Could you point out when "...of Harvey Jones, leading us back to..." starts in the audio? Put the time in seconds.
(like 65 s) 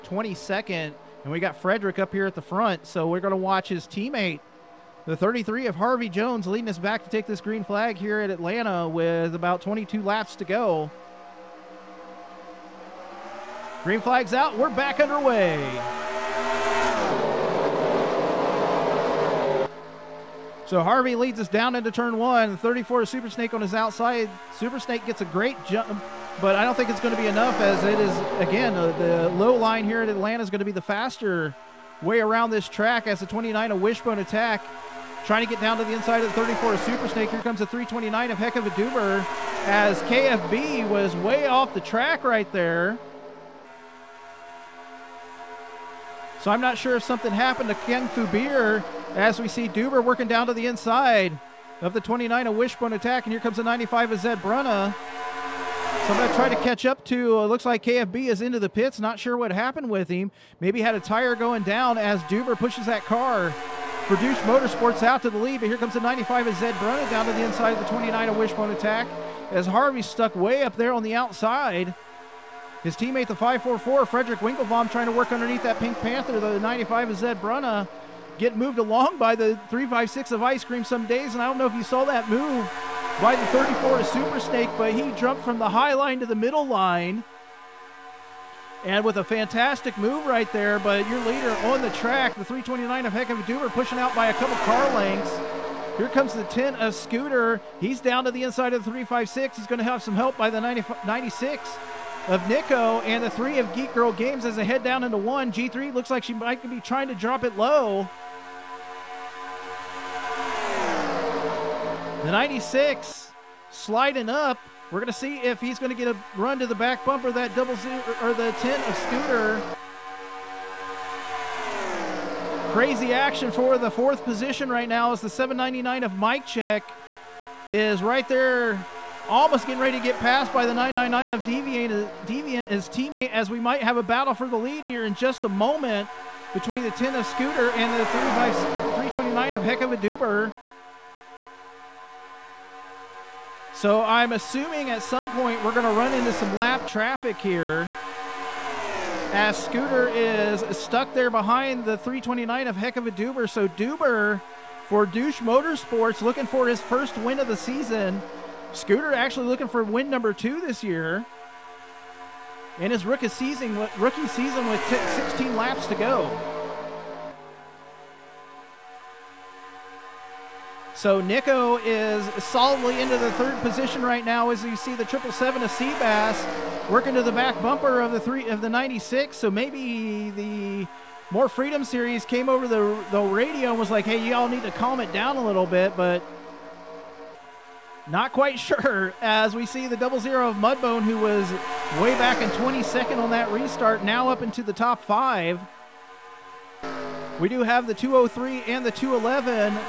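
5 s.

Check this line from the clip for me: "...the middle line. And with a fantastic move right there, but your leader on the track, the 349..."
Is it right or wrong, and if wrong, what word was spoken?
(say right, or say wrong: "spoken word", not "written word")
wrong: "329", not "349".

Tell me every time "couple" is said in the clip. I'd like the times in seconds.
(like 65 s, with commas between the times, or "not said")
94 s.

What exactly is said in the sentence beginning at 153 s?
So Duber for Douche Motorsports looking for his first win of the season.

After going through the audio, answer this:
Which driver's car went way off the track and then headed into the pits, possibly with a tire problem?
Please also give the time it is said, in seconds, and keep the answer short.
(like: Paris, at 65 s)
Ken Fubir, at 47 s.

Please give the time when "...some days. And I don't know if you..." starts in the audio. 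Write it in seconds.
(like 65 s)
80 s.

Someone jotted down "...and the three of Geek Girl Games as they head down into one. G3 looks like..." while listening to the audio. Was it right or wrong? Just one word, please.
right.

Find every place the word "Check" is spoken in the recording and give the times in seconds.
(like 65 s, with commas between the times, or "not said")
126 s.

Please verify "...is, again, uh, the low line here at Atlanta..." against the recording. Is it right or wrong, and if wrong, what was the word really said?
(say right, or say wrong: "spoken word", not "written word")
right.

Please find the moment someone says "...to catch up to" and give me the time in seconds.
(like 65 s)
56 s.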